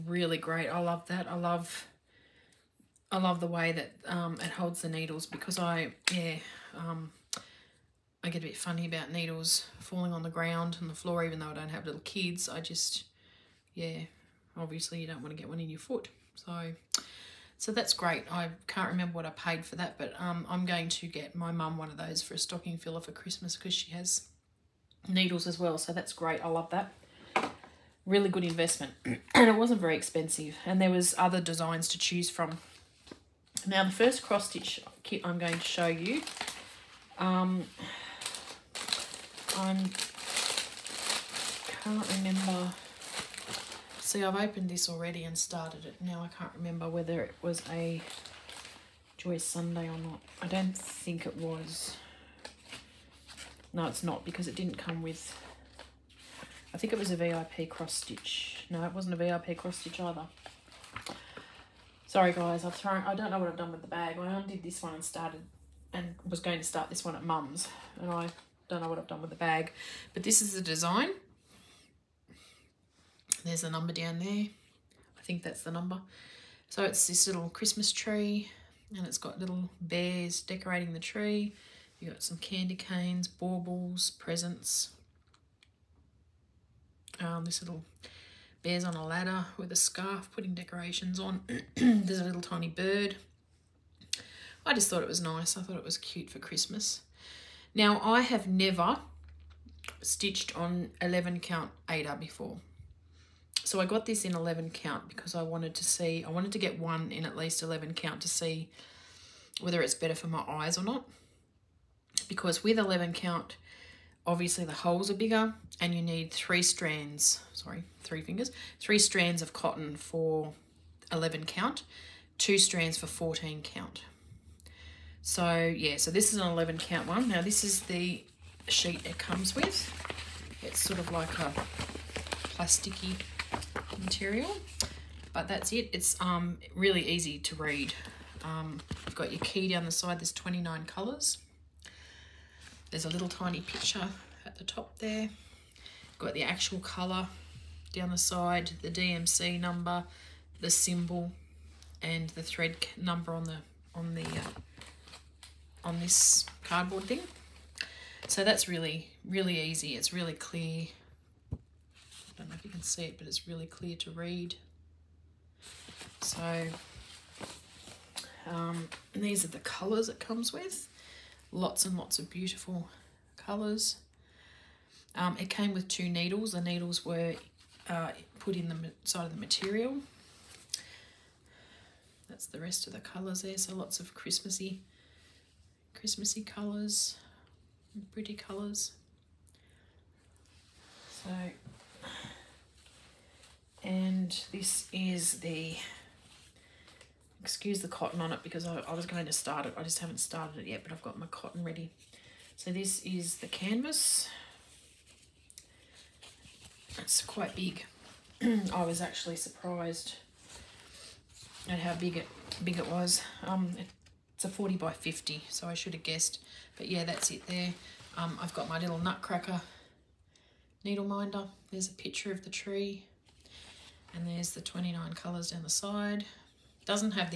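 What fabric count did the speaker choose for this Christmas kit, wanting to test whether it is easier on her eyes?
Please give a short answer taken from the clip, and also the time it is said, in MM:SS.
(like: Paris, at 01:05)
11 count, at 01:41.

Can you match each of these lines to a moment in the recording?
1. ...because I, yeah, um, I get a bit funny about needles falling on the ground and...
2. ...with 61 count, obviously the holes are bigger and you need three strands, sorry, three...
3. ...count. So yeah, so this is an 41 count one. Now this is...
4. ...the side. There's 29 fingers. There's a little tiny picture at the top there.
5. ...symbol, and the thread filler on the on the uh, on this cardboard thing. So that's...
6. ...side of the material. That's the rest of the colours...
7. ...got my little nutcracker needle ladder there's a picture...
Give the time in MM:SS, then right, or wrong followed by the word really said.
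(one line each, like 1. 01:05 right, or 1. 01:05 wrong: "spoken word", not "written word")
1. 00:05 right
2. 01:52 wrong: "11", not "61"
3. 02:03 wrong: "11", not "41"
4. 02:19 wrong: "colours", not "fingers"
5. 02:30 wrong: "number", not "filler"
6. 02:59 right
7. 03:38 wrong: "minder", not "ladder".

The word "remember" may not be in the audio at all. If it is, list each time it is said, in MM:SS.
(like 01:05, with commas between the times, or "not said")
00:18, 00:42, 00:46.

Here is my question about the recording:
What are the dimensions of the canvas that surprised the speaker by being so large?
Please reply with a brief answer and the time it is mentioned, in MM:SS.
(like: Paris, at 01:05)
40 by 50, at 03:34.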